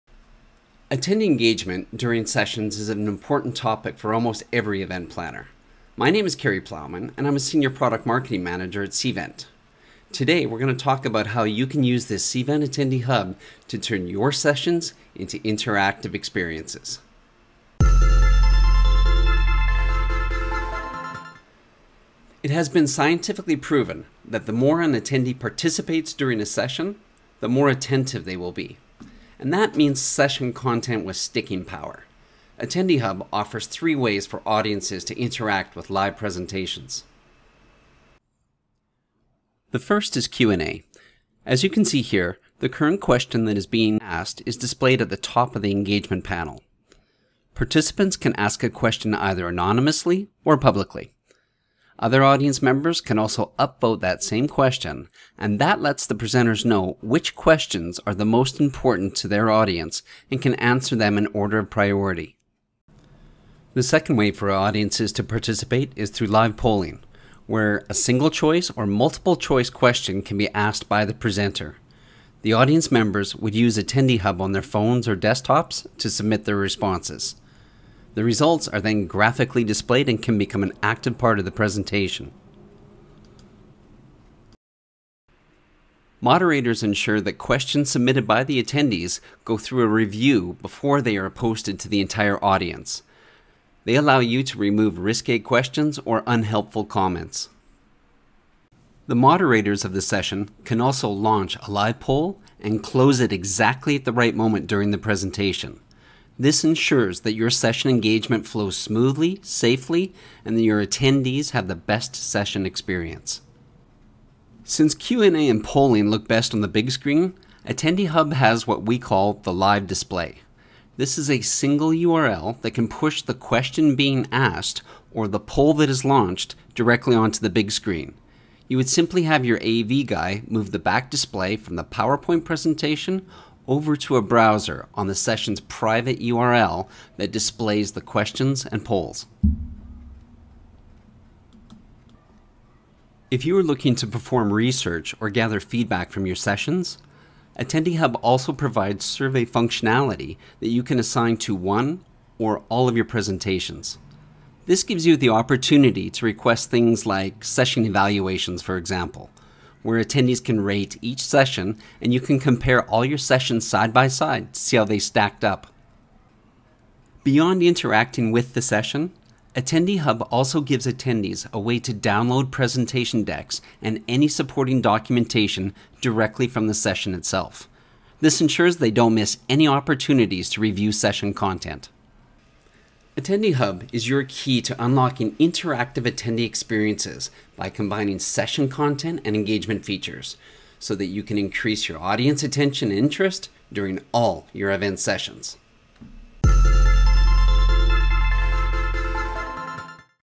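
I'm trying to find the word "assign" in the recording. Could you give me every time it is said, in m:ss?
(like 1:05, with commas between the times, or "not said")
2:30.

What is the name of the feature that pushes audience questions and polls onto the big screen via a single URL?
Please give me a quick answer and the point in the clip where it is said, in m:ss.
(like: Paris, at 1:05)
live display, at 1:59.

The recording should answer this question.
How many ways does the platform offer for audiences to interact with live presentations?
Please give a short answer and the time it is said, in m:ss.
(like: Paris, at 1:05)
3, at 0:33.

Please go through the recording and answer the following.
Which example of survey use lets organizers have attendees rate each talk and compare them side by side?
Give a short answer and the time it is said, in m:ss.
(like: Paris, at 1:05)
session evaluations, at 2:37.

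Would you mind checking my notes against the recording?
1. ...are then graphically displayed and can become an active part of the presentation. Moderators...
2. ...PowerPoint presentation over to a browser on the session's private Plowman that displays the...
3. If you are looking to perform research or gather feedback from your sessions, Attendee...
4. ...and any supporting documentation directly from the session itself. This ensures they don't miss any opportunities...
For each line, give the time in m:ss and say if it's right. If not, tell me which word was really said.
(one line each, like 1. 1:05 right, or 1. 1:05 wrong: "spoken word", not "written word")
1. 1:18 right
2. 2:11 wrong: "URL", not "Plowman"
3. 2:23 right
4. 2:53 right.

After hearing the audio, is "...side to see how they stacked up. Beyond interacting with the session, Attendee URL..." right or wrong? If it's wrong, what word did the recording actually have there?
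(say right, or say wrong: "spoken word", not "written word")
wrong: "Hub", not "URL".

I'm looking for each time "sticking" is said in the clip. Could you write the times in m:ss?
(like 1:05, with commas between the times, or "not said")
0:31.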